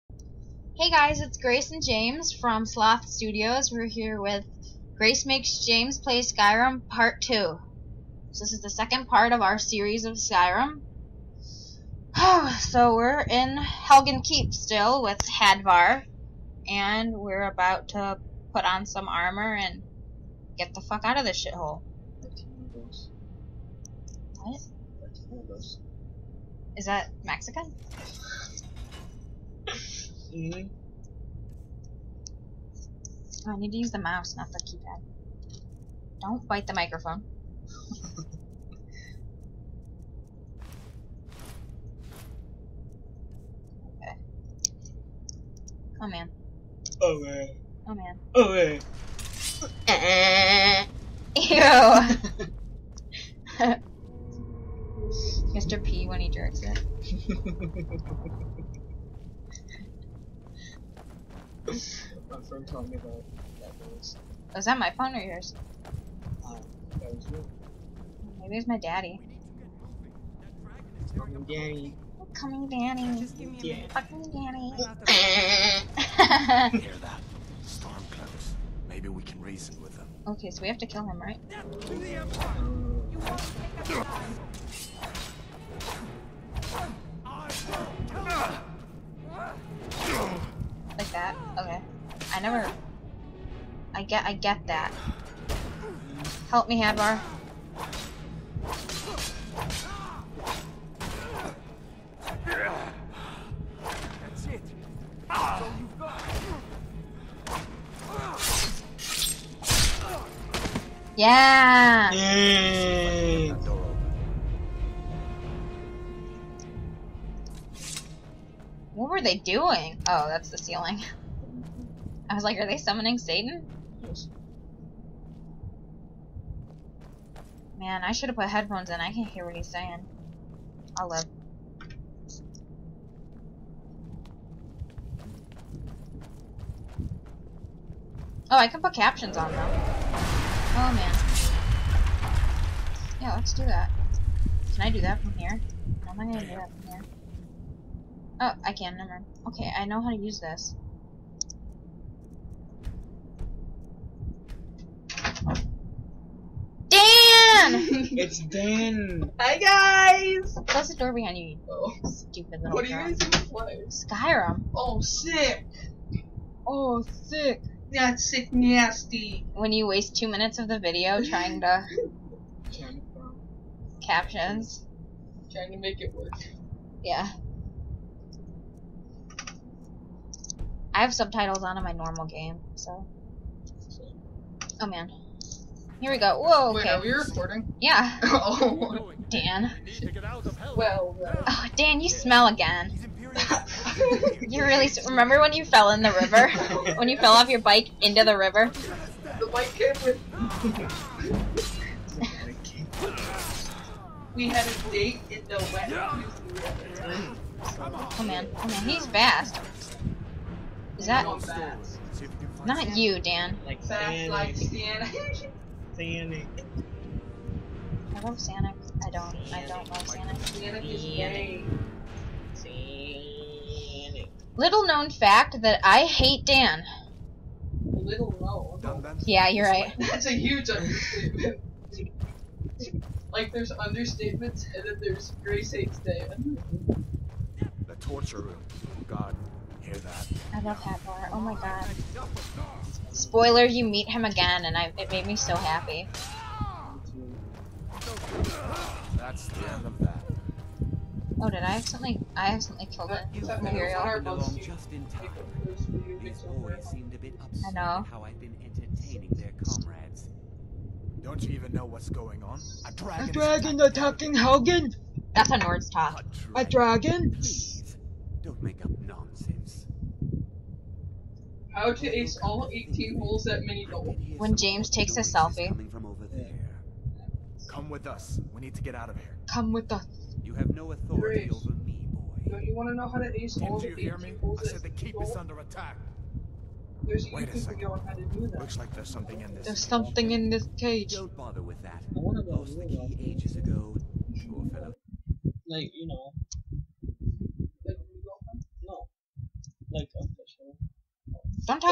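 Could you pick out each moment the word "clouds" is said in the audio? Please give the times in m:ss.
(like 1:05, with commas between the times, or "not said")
1:18.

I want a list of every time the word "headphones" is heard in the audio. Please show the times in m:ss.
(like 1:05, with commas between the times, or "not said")
2:08.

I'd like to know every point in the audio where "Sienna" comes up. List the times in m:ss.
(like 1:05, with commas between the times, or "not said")
3:34.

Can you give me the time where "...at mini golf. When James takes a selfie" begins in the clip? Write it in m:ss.
4:33.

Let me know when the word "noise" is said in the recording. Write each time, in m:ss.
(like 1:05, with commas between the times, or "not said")
1:03.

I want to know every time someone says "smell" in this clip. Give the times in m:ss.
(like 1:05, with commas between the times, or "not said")
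3:12.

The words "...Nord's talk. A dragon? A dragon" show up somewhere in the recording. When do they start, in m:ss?
4:25.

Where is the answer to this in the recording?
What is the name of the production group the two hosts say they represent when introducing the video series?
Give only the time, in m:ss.
0:02.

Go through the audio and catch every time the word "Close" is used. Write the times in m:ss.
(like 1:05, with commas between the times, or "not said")
2:40.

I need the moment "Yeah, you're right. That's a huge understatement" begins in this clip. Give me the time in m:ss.
3:49.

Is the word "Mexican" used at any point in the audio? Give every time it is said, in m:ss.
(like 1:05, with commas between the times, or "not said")
0:27.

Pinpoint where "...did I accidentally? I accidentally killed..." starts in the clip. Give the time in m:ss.
4:11.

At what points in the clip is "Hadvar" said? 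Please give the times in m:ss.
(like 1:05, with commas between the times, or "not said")
0:15, 1:36.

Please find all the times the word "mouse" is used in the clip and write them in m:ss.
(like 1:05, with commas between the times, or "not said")
0:33.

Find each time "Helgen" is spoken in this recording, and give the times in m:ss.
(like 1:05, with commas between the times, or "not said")
0:13, 4:24.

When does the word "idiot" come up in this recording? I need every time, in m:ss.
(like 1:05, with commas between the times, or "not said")
not said.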